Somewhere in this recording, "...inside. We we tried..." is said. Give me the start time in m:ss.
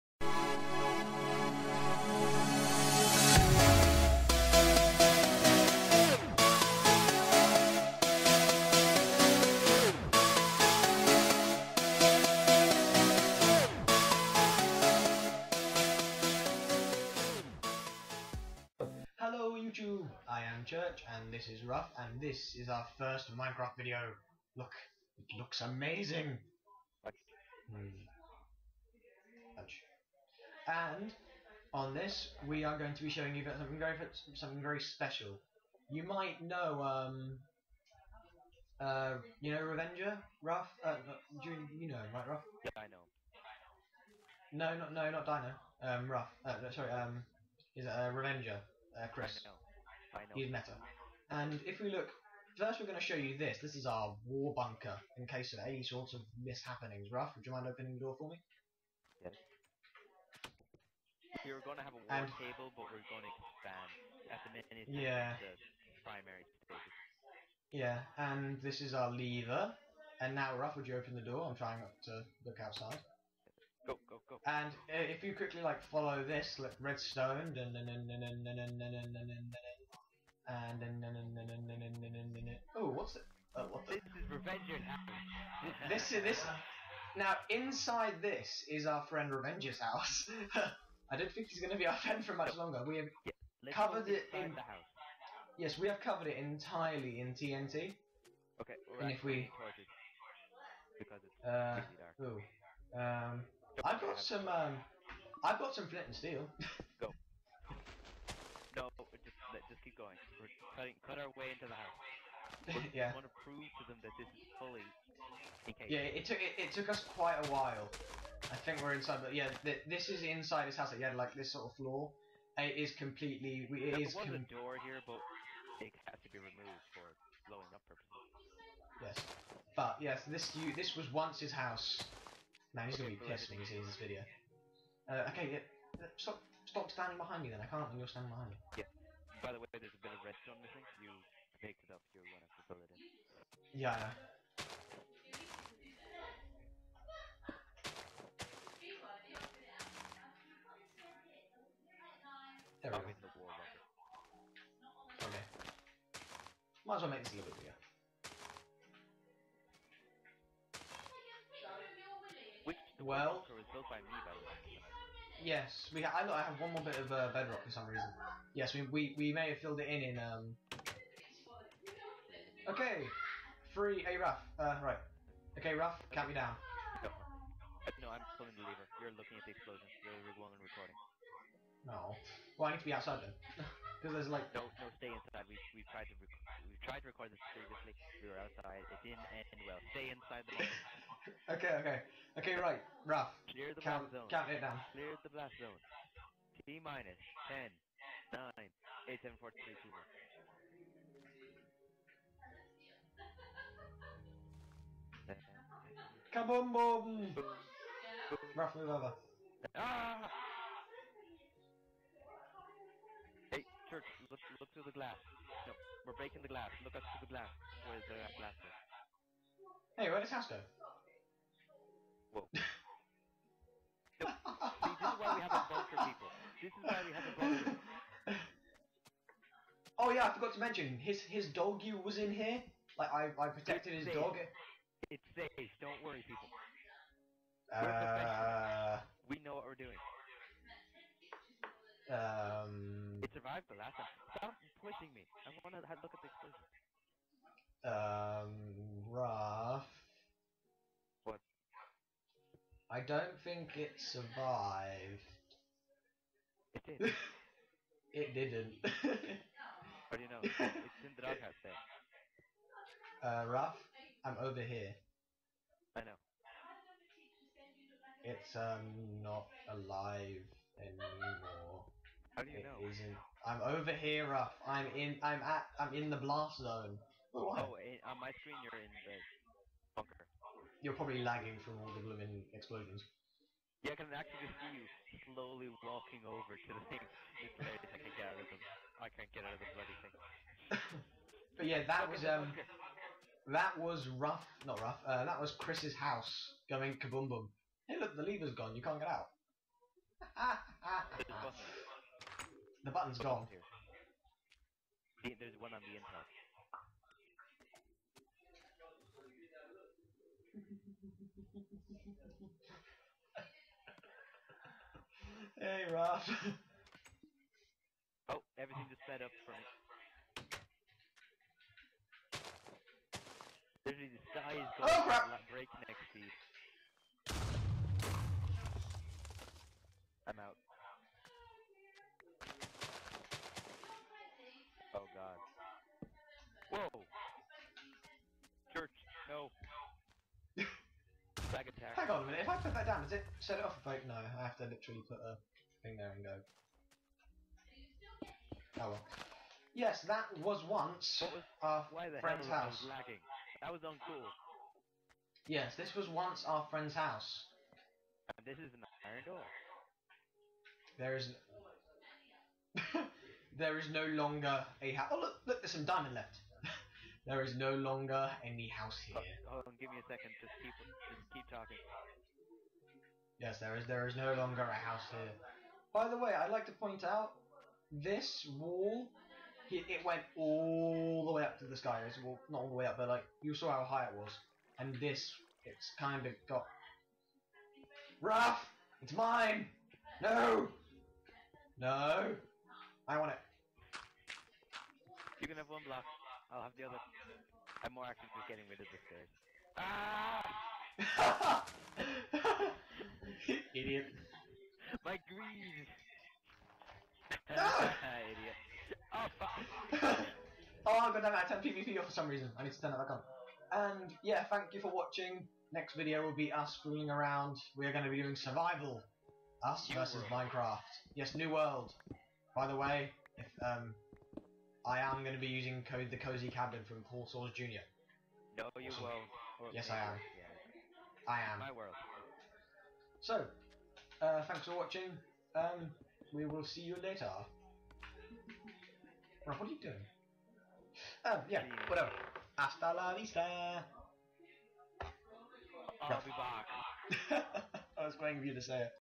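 3:05.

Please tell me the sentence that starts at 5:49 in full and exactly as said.
Yes, that was once was, our friend's house.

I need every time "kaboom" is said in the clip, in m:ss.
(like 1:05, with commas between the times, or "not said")
3:26, 4:57.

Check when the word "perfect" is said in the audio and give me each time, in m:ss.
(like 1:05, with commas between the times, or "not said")
not said.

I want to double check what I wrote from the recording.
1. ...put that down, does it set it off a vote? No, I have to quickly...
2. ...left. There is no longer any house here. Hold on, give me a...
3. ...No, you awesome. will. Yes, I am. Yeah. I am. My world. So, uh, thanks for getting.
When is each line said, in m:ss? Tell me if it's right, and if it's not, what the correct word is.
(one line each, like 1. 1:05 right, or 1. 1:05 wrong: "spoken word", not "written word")
1. 5:42 wrong: "literally", not "quickly"
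2. 6:06 right
3. 7:08 wrong: "watching", not "getting".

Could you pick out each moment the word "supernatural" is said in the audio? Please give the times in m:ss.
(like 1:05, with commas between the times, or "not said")
not said.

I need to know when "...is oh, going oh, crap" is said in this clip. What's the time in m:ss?
5:24.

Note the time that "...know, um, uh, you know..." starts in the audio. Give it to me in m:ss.
0:36.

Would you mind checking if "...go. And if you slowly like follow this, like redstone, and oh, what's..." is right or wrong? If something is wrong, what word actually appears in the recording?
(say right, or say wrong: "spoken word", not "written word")
wrong: "quickly", not "slowly".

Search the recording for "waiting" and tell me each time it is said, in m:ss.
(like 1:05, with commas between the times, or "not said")
7:28.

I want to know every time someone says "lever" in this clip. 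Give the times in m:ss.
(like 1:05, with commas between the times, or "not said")
1:09, 2:58, 4:58.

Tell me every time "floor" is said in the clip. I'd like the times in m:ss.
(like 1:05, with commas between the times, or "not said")
2:01.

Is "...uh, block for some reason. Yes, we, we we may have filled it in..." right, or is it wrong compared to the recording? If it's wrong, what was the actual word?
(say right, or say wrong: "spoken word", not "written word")
wrong: "bedrock", not "block".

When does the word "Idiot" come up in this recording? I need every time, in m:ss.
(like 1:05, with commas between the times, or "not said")
6:43, 6:49.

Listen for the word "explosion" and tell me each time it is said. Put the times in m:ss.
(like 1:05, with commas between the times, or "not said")
2:59, 4:06, 4:42.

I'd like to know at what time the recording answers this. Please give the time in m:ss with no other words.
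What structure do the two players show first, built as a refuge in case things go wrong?
0:54.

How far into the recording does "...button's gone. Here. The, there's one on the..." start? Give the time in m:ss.
5:02.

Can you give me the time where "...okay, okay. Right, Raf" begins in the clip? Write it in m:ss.
3:11.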